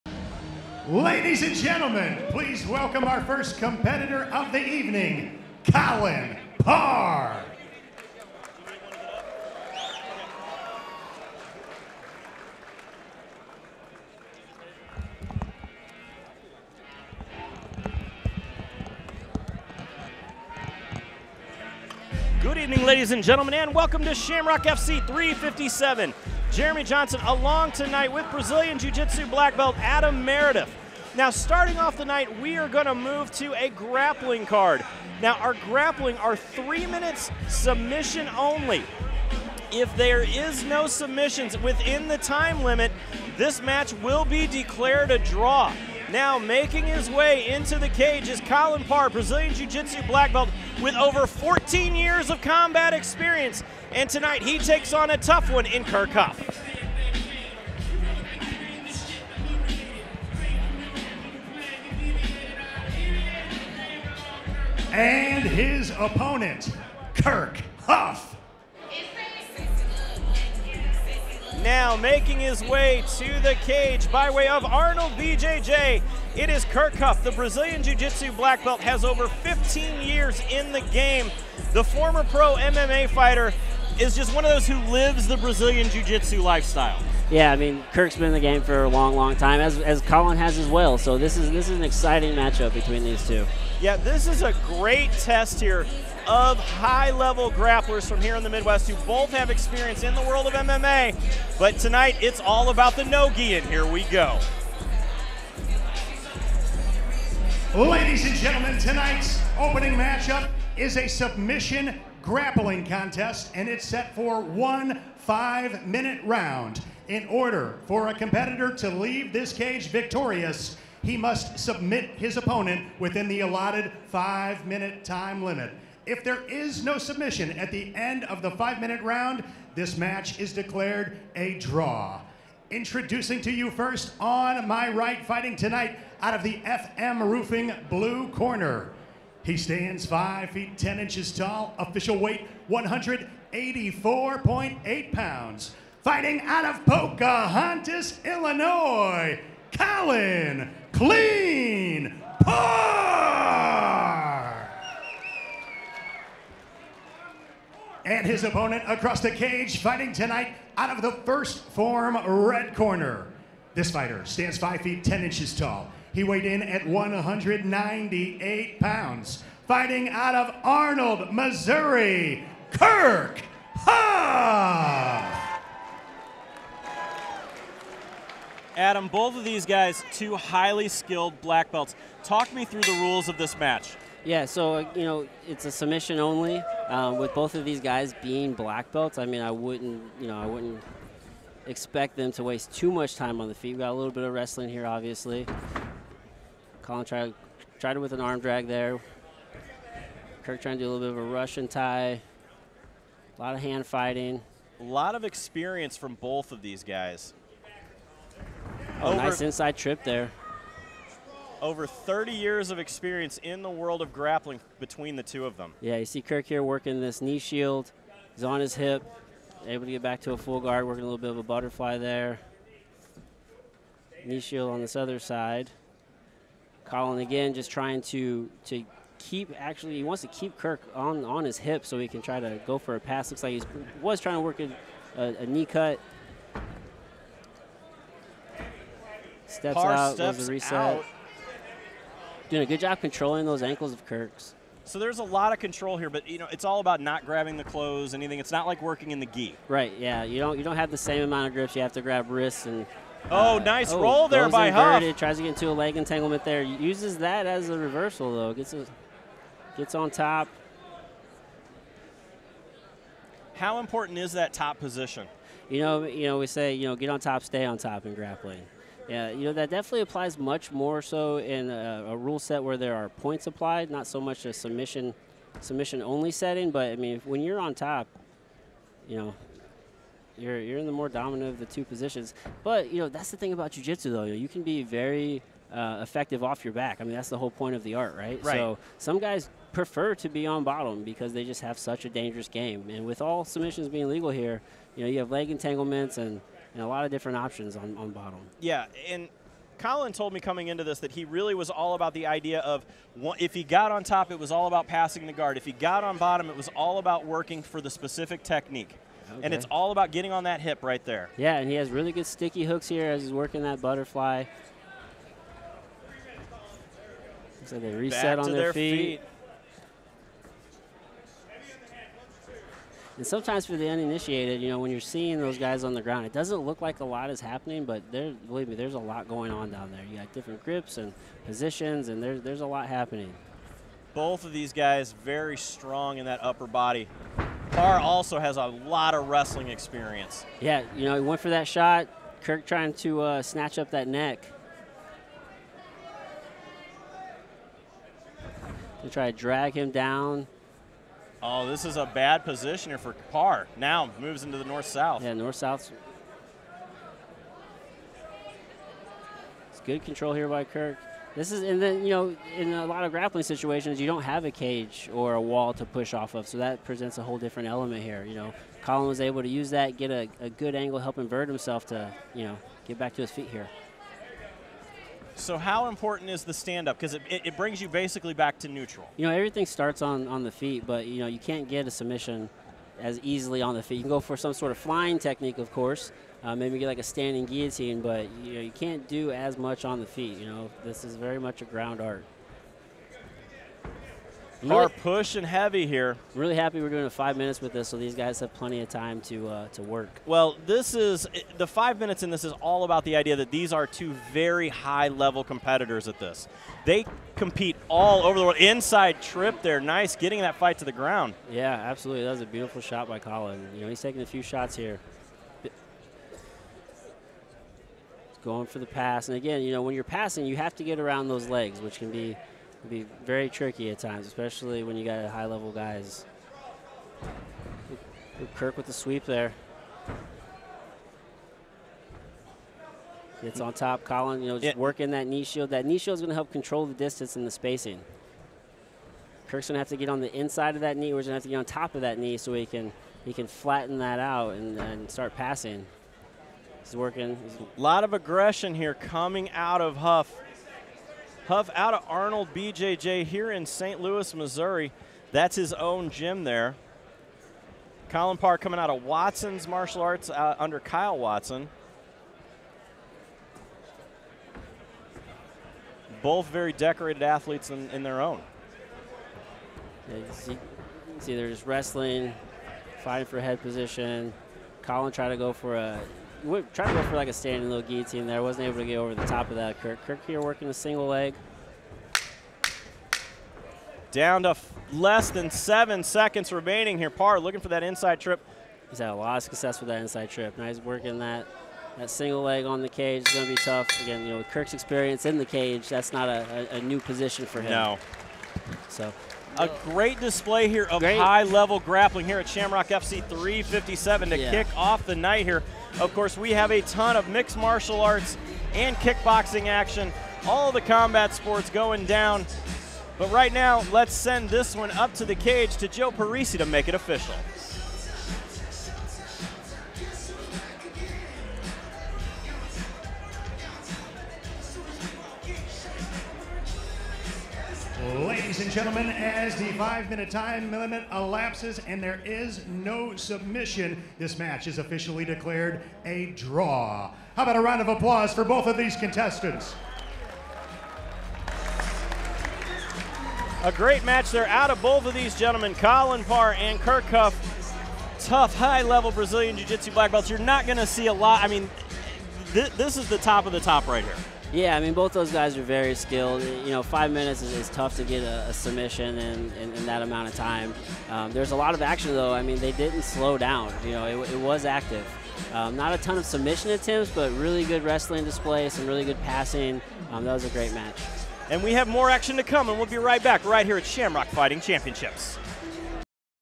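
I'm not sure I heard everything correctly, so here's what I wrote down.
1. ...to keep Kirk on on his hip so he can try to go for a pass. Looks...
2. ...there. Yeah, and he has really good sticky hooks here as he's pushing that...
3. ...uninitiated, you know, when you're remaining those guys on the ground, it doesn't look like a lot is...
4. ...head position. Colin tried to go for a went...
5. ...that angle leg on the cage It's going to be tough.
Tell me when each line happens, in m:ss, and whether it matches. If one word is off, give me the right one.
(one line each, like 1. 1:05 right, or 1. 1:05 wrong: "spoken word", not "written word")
1. 3:50 right
2. 5:11 wrong: "working", not "pushing"
3. 5:23 wrong: "seeing", not "remaining"
4. 7:53 right
5. 8:11 wrong: "single", not "angle".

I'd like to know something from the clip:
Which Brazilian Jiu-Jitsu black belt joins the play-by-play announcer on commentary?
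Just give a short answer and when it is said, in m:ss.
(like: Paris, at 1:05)
Adam Meredith, at 0:29.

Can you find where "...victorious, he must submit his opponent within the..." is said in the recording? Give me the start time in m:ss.
1:59.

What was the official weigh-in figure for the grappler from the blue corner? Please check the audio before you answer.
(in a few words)
184.8 pounds.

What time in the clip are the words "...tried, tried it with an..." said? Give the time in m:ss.
3:17.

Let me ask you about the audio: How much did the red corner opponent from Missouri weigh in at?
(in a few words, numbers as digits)
198 pounds.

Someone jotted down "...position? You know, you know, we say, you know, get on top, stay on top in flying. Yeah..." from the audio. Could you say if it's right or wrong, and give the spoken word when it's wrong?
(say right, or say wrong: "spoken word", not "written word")
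wrong: "grappling", not "flying".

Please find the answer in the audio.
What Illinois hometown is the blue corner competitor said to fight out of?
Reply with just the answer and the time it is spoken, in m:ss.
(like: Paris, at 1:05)
Pocahontas, Illinois, at 2:26.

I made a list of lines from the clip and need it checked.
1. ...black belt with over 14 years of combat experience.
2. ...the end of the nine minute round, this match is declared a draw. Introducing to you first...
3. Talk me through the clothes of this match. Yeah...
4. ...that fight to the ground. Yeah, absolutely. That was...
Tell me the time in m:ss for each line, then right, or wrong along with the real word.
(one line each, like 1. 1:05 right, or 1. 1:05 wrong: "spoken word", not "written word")
1. 0:50 right
2. 2:07 wrong: "five", not "nine"
3. 3:02 wrong: "rules", not "clothes"
4. 6:50 right.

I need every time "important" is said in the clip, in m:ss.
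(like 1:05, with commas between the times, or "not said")
4:23, 6:15.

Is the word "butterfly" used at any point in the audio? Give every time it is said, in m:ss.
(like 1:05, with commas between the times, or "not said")
3:41, 5:13.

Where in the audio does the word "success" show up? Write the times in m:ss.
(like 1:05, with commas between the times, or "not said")
8:09.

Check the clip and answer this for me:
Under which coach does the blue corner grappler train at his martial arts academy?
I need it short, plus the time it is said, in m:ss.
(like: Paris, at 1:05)
Kyle Watson, at 7:40.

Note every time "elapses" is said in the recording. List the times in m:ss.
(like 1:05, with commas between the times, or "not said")
8:51.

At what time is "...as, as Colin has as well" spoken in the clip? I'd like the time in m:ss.
1:29.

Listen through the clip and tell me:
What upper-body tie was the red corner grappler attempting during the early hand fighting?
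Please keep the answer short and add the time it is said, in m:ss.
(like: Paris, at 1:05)
Russian tie, at 3:21.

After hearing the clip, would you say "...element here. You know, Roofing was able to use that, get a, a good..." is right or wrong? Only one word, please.
wrong.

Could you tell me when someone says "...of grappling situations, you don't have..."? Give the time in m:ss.
6:03.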